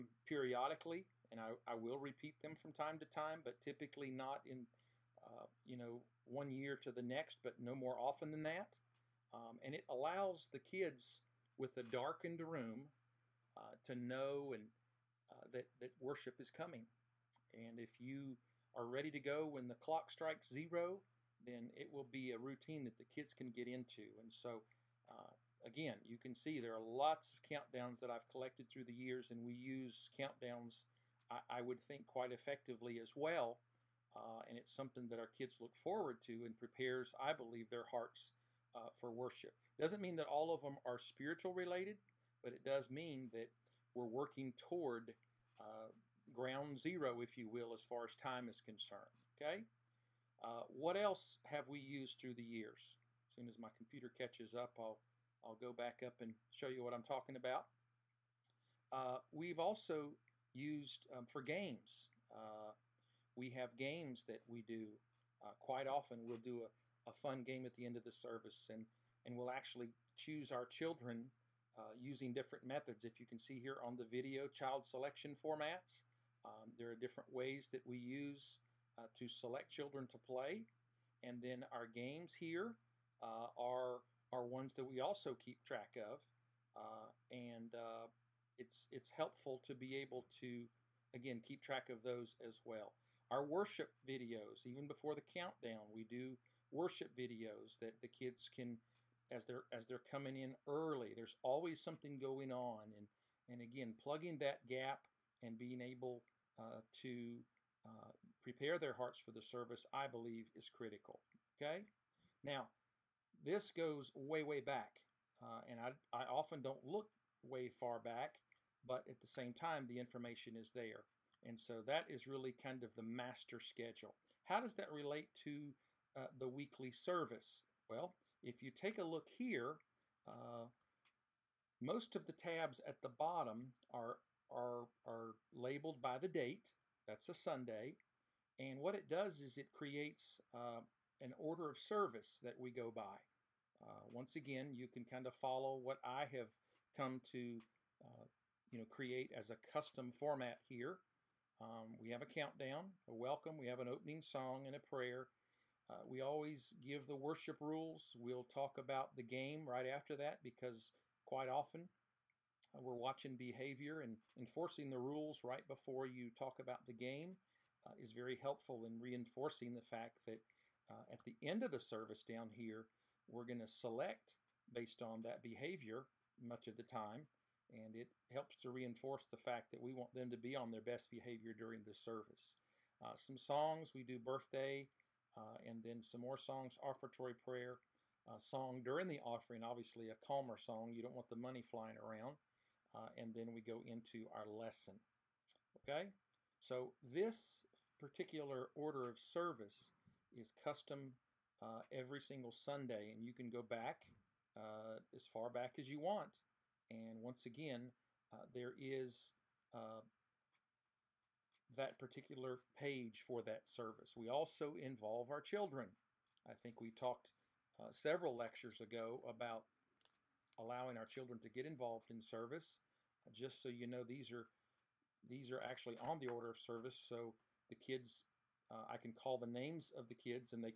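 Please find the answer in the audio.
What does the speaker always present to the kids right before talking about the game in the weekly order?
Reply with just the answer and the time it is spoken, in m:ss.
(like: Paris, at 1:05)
the worship rules, at 2:37.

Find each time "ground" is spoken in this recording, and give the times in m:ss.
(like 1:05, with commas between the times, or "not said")
0:46.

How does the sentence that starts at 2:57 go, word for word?
And it helps to reinforce the fact that we want them to be on their best behavior during the service.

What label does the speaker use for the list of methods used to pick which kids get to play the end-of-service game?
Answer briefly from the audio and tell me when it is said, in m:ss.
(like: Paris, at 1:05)
child selection formats, at 1:14.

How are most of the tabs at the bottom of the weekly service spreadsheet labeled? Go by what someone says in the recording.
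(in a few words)
by the date.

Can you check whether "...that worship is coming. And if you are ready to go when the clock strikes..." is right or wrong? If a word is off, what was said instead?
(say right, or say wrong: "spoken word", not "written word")
right.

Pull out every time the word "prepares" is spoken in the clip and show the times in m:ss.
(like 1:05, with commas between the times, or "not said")
0:36, 1:48.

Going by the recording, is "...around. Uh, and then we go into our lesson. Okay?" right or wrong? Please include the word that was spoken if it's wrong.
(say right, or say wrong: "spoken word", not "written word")
right.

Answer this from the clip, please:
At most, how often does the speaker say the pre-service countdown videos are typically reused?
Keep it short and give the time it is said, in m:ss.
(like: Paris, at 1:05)
one year to the next, at 0:06.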